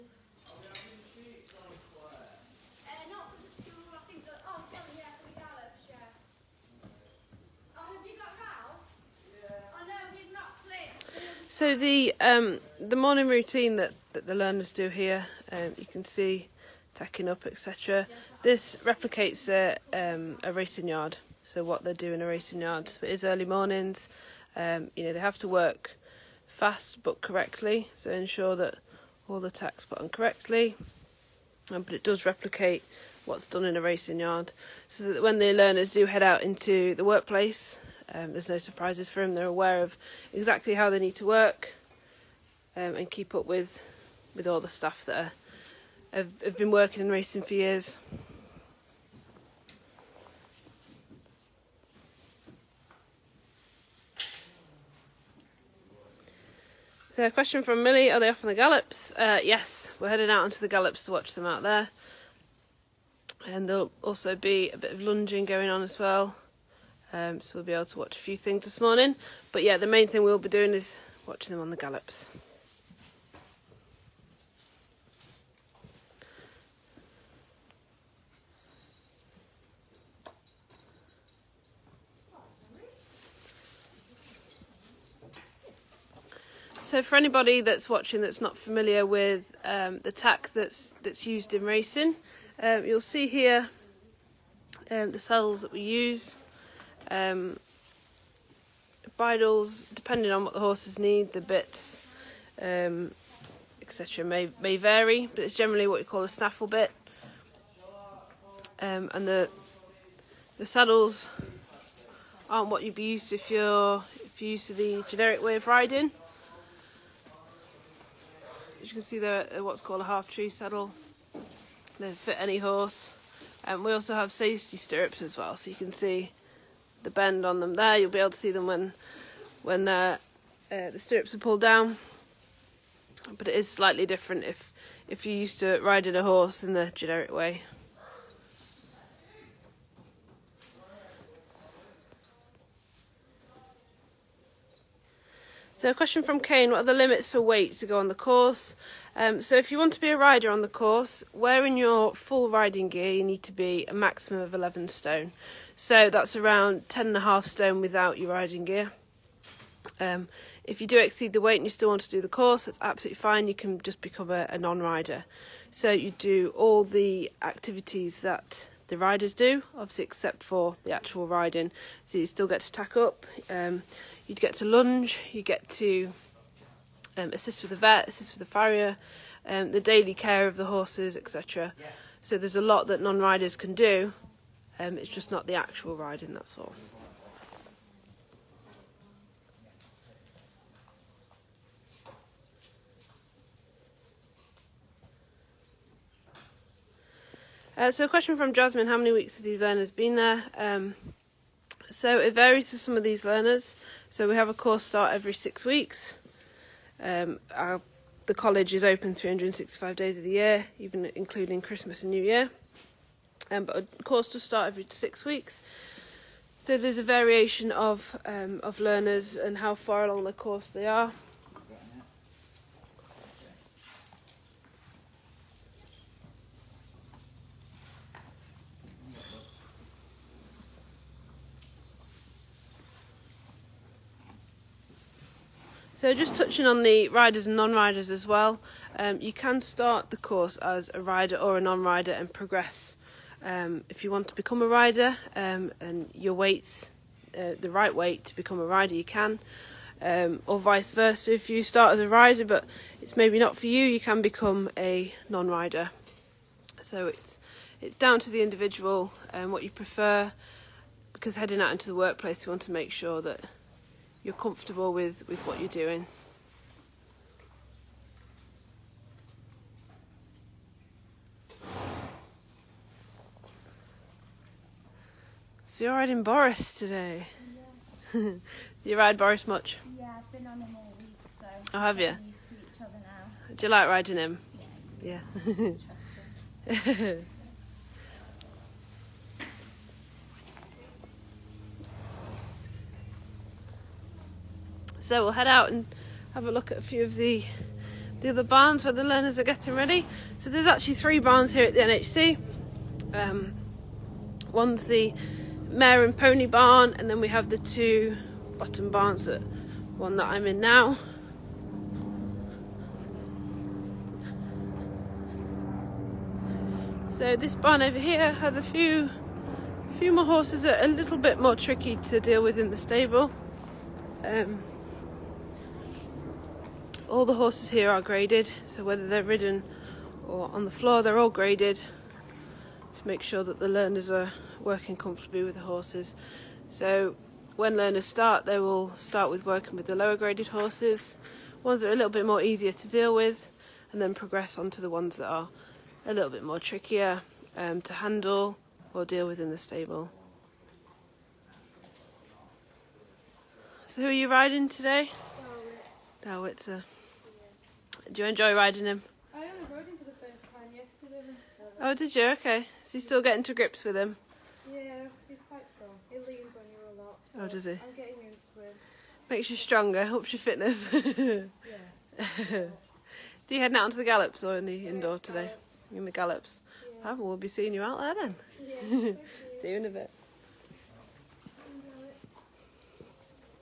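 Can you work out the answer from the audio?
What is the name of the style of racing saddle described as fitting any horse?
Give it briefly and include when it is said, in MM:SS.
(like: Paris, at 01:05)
Half tree saddle, at 02:00.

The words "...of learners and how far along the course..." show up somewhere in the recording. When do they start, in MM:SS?
03:38.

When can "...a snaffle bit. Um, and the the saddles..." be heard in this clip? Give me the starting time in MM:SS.
01:46.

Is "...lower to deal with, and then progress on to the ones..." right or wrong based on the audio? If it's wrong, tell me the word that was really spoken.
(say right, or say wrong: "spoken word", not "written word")
wrong: "easier", not "lower".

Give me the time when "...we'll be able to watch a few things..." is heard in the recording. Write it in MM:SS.
01:07.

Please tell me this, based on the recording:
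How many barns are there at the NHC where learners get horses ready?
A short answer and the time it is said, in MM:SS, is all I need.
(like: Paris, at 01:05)
3, at 05:00.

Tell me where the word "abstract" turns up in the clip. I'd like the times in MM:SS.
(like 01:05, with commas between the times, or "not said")
not said.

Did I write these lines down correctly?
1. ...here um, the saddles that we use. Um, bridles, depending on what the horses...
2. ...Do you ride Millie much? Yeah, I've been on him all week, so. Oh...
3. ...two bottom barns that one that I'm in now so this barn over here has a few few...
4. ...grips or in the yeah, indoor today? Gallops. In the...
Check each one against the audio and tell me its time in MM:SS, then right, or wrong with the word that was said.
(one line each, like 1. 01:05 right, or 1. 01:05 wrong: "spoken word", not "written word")
1. 01:33 right
2. 04:38 wrong: "Boris", not "Millie"
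3. 05:07 right
4. 06:14 wrong: "gallops", not "grips".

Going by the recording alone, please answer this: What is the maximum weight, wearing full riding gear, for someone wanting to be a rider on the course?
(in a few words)
11 stone.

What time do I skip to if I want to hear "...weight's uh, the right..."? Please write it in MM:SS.
04:06.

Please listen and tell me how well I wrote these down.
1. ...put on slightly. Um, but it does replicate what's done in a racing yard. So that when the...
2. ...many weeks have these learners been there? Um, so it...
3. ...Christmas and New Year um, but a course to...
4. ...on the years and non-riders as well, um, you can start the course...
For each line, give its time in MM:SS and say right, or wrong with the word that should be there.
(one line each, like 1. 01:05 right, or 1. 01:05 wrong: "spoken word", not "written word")
1. 00:29 wrong: "correctly", not "slightly"
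2. 03:18 right
3. 03:31 right
4. 03:56 wrong: "riders", not "years".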